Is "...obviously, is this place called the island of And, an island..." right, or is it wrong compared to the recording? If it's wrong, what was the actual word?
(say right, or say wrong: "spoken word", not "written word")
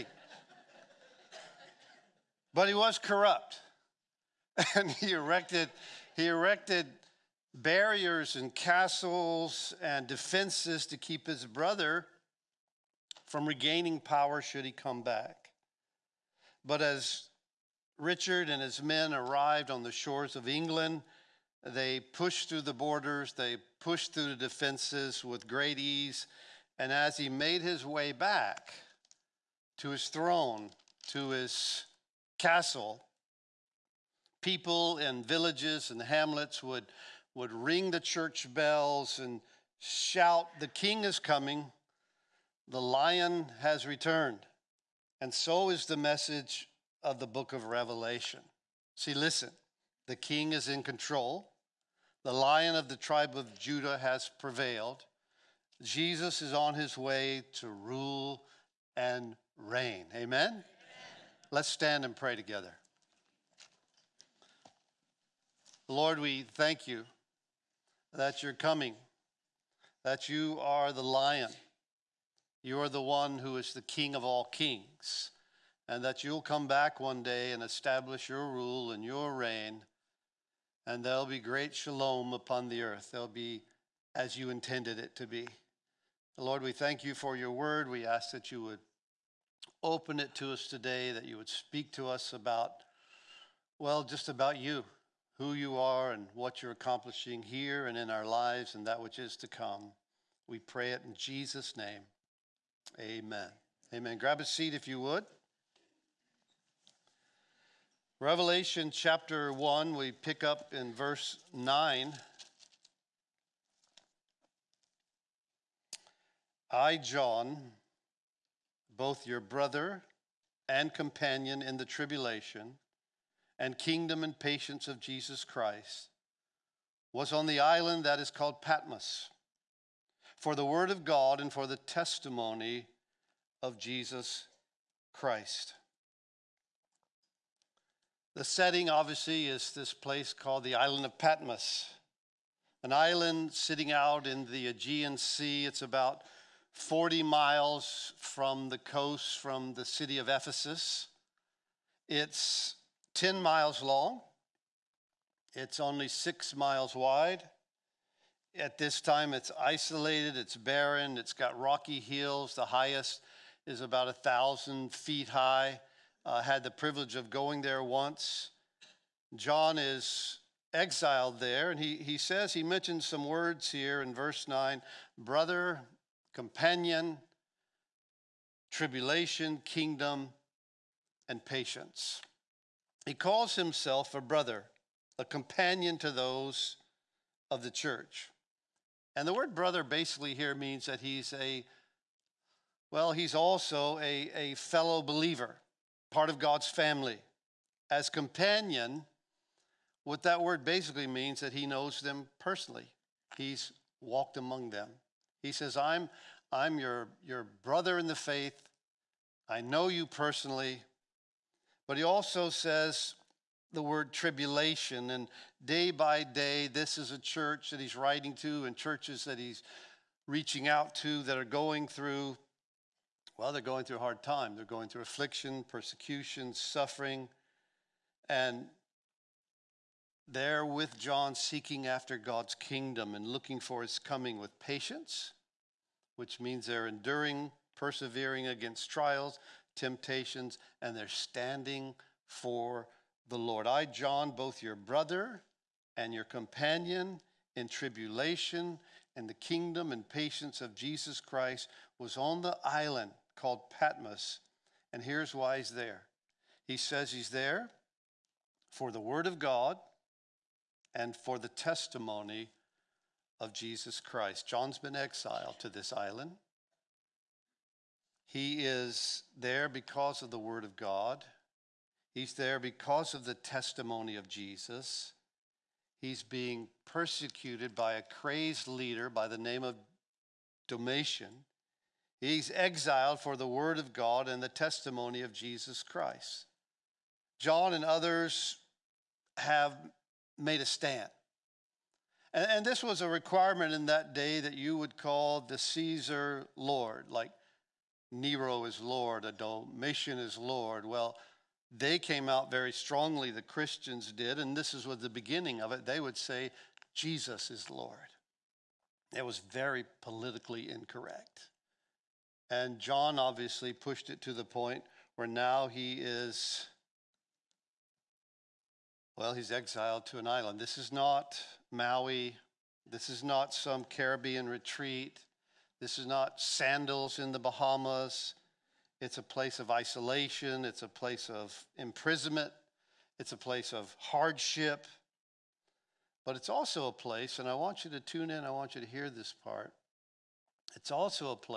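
wrong: "Patmos", not "And".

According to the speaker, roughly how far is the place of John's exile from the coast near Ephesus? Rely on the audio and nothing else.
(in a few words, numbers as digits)
40 miles.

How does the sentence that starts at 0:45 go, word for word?
And so is the message of the book of Revelation.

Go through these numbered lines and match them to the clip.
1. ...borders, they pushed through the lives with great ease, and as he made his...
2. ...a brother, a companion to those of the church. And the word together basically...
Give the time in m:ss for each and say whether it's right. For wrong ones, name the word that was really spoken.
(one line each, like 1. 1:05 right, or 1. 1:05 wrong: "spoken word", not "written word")
1. 0:22 wrong: "defenses", not "lives"
2. 3:04 wrong: "brother", not "together".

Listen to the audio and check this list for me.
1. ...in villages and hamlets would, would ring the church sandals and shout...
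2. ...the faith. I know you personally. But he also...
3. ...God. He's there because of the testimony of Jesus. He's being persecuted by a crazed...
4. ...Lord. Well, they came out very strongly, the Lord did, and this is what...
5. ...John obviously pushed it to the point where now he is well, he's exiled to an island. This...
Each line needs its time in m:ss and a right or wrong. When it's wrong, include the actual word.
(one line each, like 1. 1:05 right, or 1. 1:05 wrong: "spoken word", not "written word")
1. 0:34 wrong: "bells", not "sandals"
2. 3:28 right
3. 4:30 right
4. 5:00 wrong: "Christians", not "Lord"
5. 5:12 right.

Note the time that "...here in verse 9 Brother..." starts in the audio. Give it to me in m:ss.
2:53.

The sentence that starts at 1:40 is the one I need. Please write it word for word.
We pray it in Jesus' name.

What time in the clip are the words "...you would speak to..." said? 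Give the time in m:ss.
1:31.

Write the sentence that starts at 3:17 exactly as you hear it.
As companion, what that word basically means that he knows them personally.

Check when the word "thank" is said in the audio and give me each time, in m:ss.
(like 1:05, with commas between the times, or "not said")
1:06, 1:26.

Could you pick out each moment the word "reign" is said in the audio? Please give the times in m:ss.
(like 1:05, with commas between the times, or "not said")
0:59, 1:19.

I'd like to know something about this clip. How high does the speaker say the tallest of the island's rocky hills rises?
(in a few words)
about 1000 feet.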